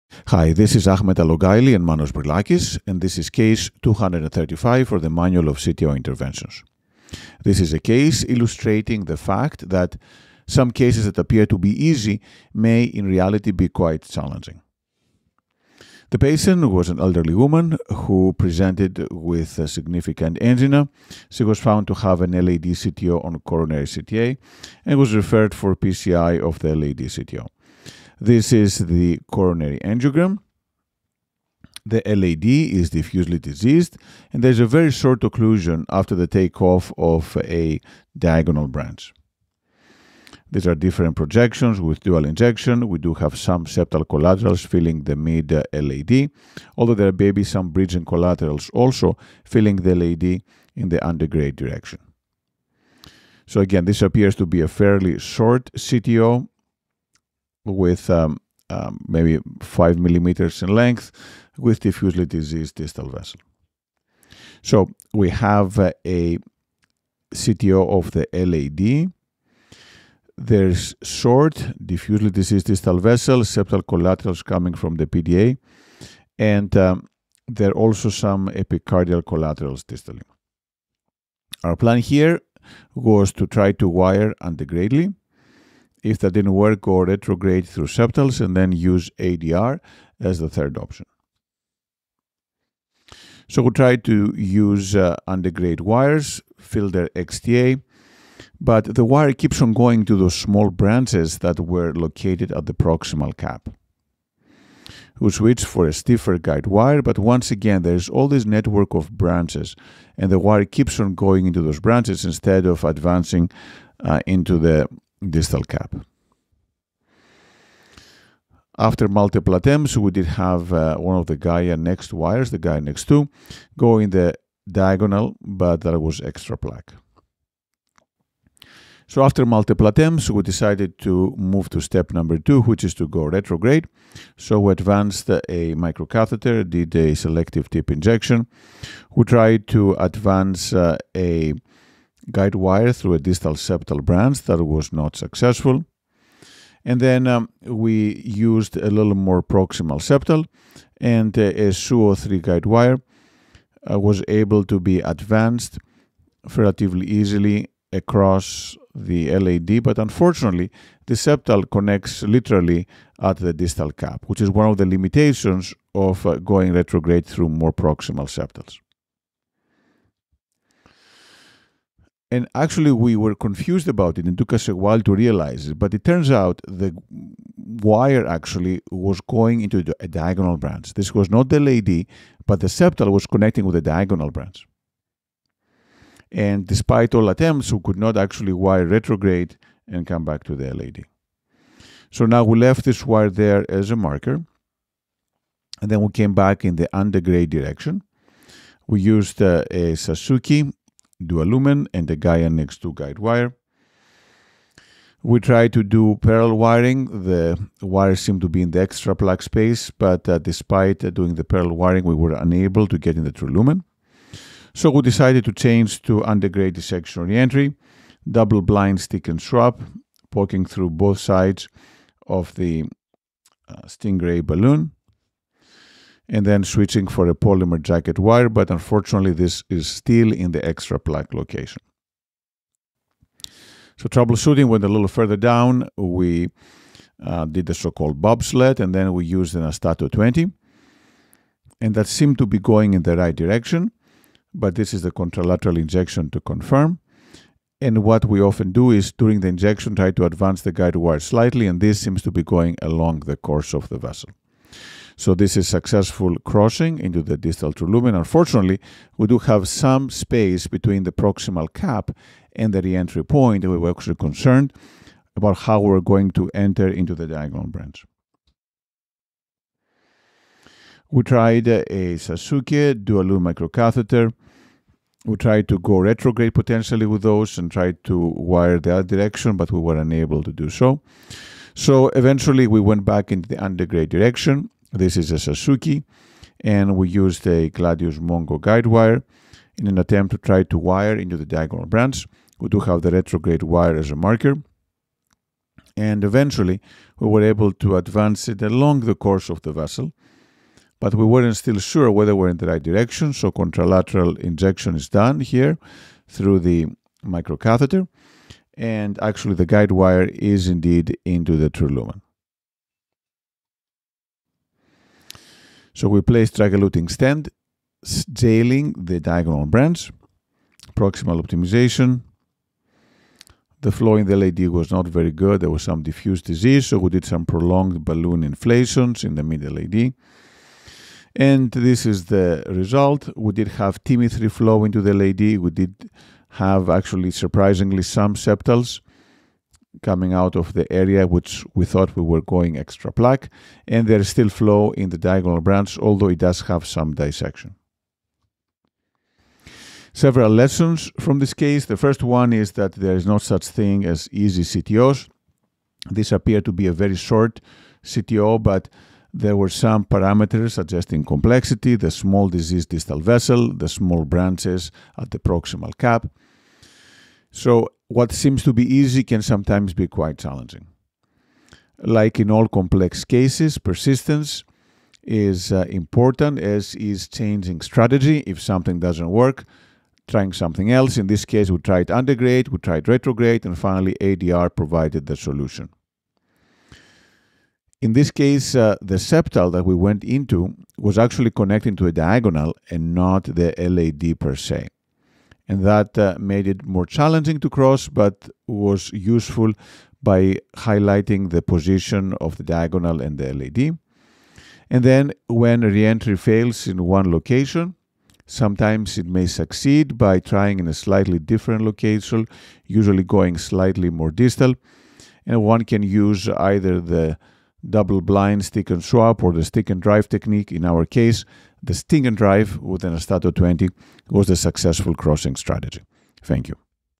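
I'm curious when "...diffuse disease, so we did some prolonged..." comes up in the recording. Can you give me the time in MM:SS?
05:26.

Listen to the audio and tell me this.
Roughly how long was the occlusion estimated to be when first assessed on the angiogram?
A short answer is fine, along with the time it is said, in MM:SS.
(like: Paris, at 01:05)
5 millimeters, at 00:59.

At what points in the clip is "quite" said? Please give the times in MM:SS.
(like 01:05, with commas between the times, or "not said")
00:13, 06:10.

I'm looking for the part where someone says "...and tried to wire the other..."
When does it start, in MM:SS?
04:37.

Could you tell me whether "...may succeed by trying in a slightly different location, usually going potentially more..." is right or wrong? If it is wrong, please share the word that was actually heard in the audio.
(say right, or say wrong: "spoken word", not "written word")
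wrong: "slightly", not "potentially".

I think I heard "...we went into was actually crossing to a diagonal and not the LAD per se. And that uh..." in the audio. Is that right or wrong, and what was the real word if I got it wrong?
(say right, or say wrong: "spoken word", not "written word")
wrong: "connecting", not "crossing".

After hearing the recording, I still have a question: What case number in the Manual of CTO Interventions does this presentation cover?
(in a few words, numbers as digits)
235.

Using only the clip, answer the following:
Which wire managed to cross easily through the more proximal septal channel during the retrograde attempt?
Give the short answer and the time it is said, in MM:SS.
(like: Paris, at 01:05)
Suoh 03, at 02:31.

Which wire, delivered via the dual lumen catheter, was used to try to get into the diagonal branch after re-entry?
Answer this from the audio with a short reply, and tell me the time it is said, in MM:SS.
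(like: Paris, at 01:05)
Gladius Mongo, at 04:47.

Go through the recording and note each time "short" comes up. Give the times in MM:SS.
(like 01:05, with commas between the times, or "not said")
00:34, 00:55, 01:11, 05:57.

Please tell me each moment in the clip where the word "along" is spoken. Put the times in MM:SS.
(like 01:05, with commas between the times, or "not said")
04:12, 04:58.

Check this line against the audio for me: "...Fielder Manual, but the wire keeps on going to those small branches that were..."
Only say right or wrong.
wrong.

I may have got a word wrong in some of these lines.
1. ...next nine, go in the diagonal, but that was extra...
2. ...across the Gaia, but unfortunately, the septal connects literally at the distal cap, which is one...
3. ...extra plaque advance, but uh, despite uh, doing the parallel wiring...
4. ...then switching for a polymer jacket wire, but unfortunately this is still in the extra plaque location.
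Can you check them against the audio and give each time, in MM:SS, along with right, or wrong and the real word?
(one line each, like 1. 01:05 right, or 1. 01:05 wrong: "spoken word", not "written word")
1. 02:02 wrong: "two", not "nine"
2. 02:37 wrong: "LAD", not "Gaia"
3. 03:28 wrong: "space", not "advance"
4. 03:46 right.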